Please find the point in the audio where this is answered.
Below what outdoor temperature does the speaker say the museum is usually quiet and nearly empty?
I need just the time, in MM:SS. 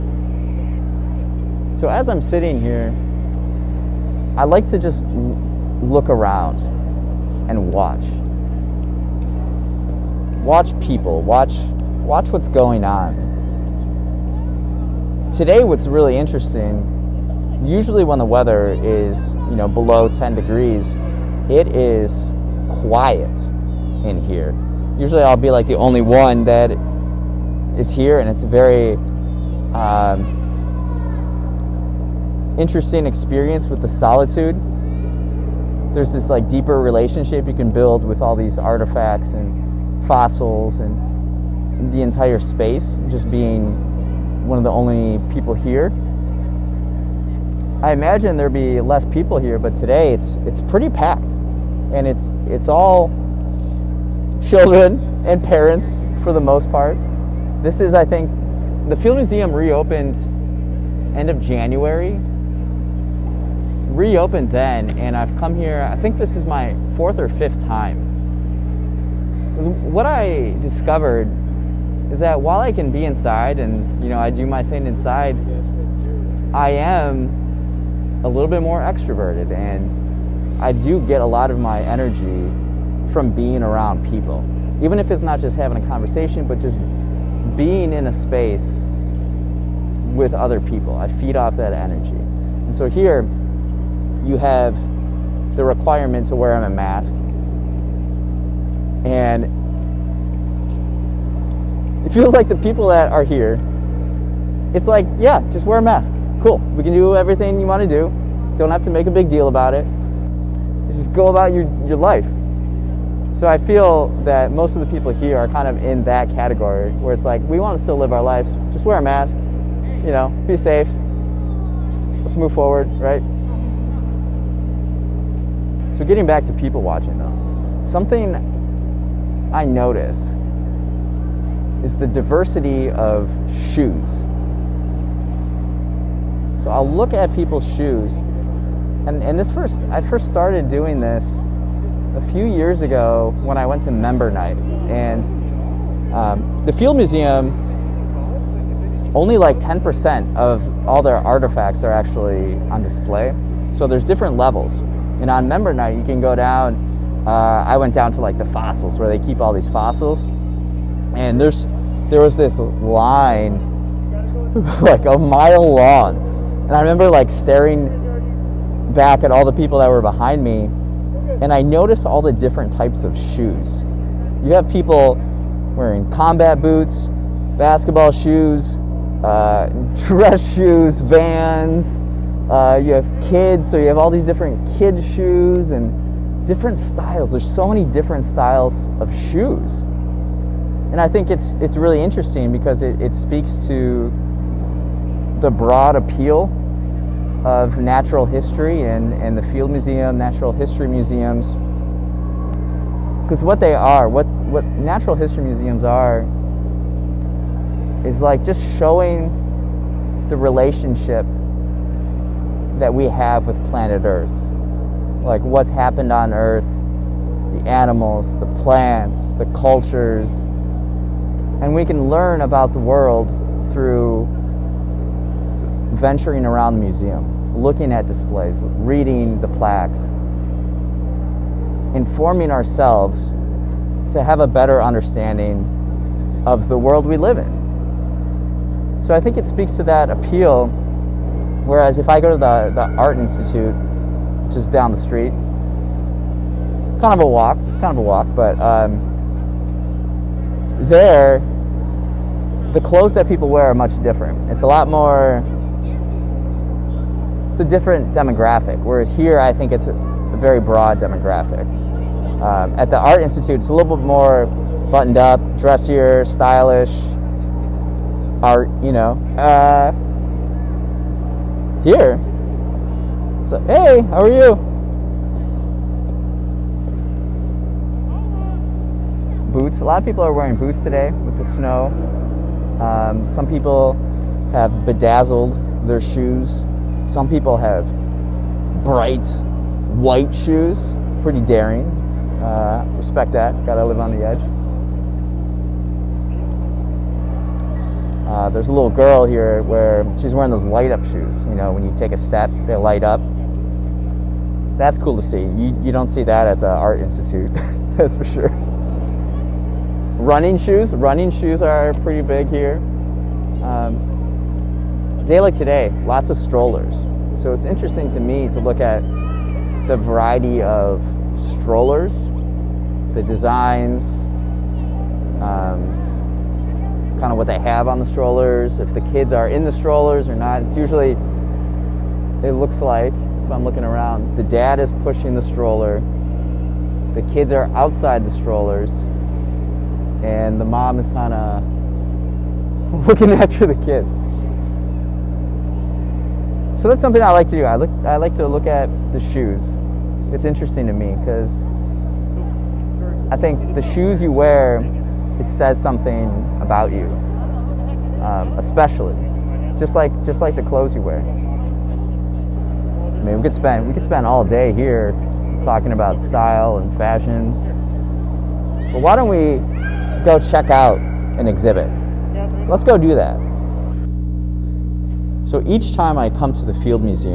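00:20.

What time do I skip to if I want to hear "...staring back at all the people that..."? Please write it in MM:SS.
02:47.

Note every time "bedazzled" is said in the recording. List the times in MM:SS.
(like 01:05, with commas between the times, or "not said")
04:44.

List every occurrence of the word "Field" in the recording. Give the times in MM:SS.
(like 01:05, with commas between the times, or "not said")
00:58, 02:26, 03:19, 06:16.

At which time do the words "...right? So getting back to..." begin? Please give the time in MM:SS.
02:02.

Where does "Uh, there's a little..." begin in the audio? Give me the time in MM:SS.
04:58.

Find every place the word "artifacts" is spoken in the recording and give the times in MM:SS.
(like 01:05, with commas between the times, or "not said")
00:38, 02:31.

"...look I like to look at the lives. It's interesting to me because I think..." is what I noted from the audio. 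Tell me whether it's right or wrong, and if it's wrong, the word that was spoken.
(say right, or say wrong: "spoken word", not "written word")
wrong: "shoes", not "lives".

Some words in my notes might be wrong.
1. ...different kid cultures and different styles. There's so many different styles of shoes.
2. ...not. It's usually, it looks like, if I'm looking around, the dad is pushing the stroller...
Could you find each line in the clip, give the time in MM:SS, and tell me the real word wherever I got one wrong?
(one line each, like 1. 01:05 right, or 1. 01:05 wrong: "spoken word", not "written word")
1. 03:04 wrong: "shoes", not "cultures"
2. 05:30 right.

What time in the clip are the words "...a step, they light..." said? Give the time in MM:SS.
05:02.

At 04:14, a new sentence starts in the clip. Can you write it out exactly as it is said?
It's a lot more it's a different demographic.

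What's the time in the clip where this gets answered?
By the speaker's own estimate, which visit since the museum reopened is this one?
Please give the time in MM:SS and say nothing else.
01:06.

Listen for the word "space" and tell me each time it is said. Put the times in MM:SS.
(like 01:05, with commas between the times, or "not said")
00:42, 01:28.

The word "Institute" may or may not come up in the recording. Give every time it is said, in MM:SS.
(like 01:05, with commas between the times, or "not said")
04:03, 04:23, 05:07.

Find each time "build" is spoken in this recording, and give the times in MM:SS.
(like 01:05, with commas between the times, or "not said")
00:37.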